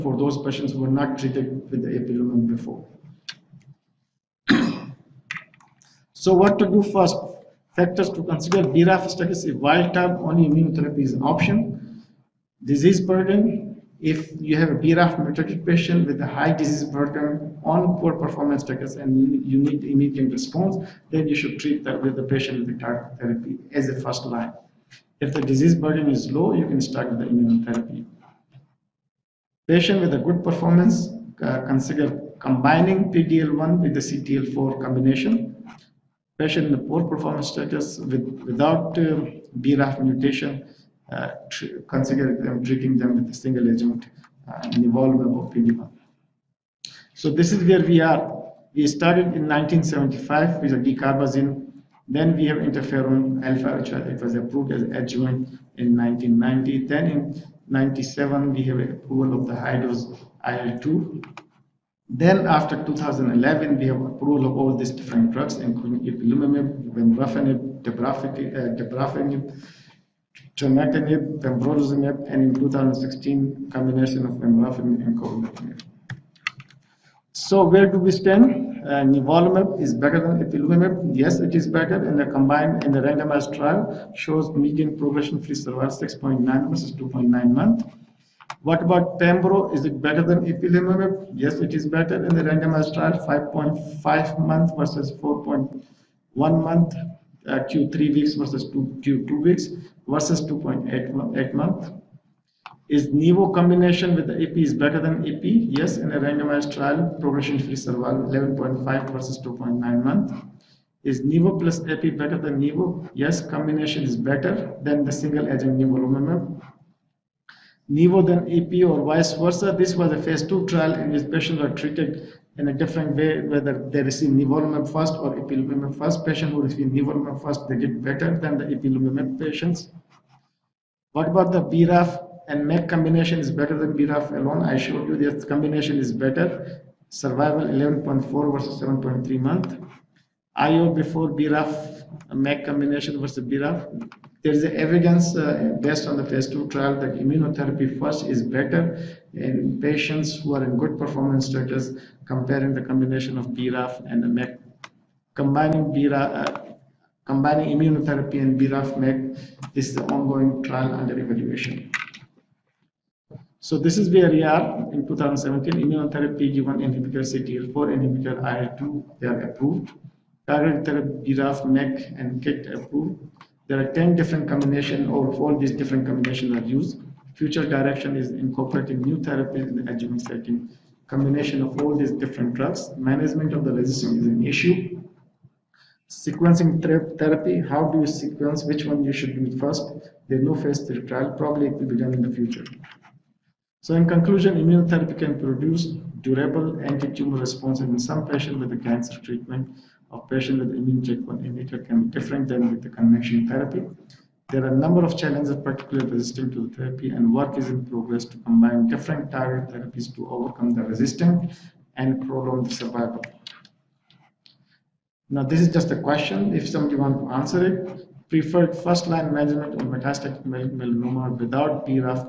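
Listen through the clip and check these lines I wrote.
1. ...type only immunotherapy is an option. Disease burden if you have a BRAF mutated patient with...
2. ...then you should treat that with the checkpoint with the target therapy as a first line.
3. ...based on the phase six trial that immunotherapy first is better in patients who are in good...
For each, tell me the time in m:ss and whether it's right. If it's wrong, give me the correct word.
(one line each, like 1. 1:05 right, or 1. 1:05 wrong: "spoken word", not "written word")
1. 0:09 right
2. 0:21 wrong: "patient", not "checkpoint"
3. 2:25 wrong: "two", not "six".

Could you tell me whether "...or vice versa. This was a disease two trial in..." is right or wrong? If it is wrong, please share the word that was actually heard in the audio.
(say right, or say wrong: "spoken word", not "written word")
wrong: "phase", not "disease".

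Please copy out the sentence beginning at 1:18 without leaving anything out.
Uh, nivolumab is better than ipilimumab.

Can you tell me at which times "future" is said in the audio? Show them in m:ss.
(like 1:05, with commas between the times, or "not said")
2:57, 3:12.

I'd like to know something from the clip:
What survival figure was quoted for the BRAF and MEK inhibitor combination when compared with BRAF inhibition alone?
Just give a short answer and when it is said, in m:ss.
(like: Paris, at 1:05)
11.4 months, at 2:17.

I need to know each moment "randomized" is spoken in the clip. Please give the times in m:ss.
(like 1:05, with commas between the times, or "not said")
1:22, 1:32, 1:46.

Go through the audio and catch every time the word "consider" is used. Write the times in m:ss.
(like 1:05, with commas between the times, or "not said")
0:08, 0:31, 0:41.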